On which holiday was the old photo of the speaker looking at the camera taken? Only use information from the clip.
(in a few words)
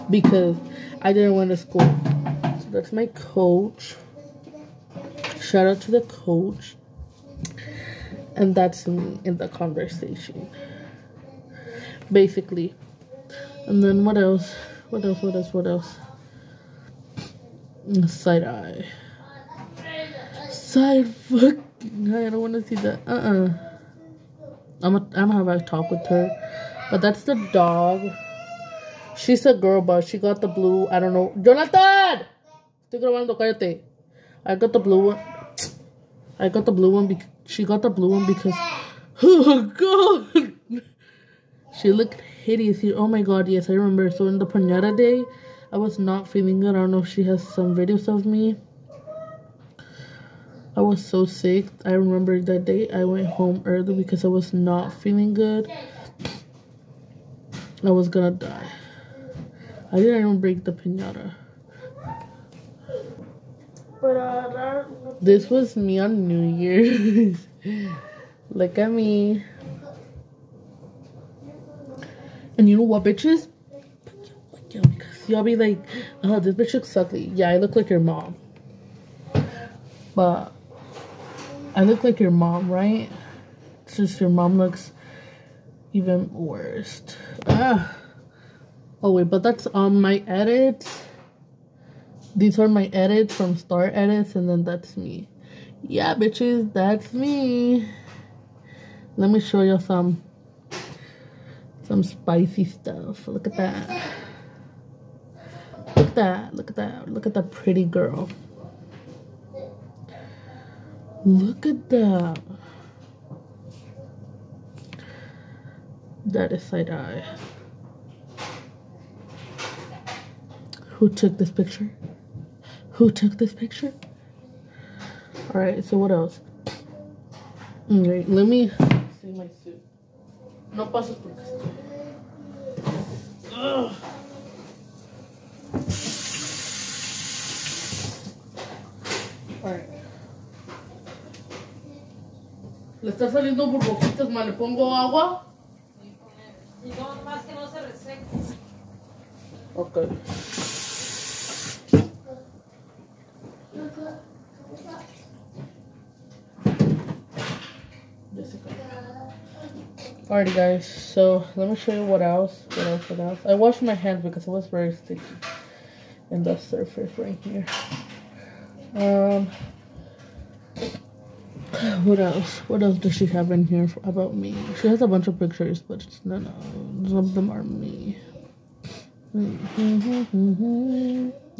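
New Year's.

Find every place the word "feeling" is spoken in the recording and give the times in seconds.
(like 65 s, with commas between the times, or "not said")
46 s, 54 s.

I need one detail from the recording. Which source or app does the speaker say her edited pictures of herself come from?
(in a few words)
Star Edits.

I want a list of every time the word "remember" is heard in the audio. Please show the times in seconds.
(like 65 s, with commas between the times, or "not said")
43 s, 51 s.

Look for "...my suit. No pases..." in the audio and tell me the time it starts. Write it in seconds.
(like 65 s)
129 s.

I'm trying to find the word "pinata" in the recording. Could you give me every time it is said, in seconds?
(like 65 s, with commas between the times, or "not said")
44 s, 60 s.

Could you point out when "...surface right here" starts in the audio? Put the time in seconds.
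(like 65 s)
166 s.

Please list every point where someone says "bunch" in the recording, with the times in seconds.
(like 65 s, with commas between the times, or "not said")
175 s.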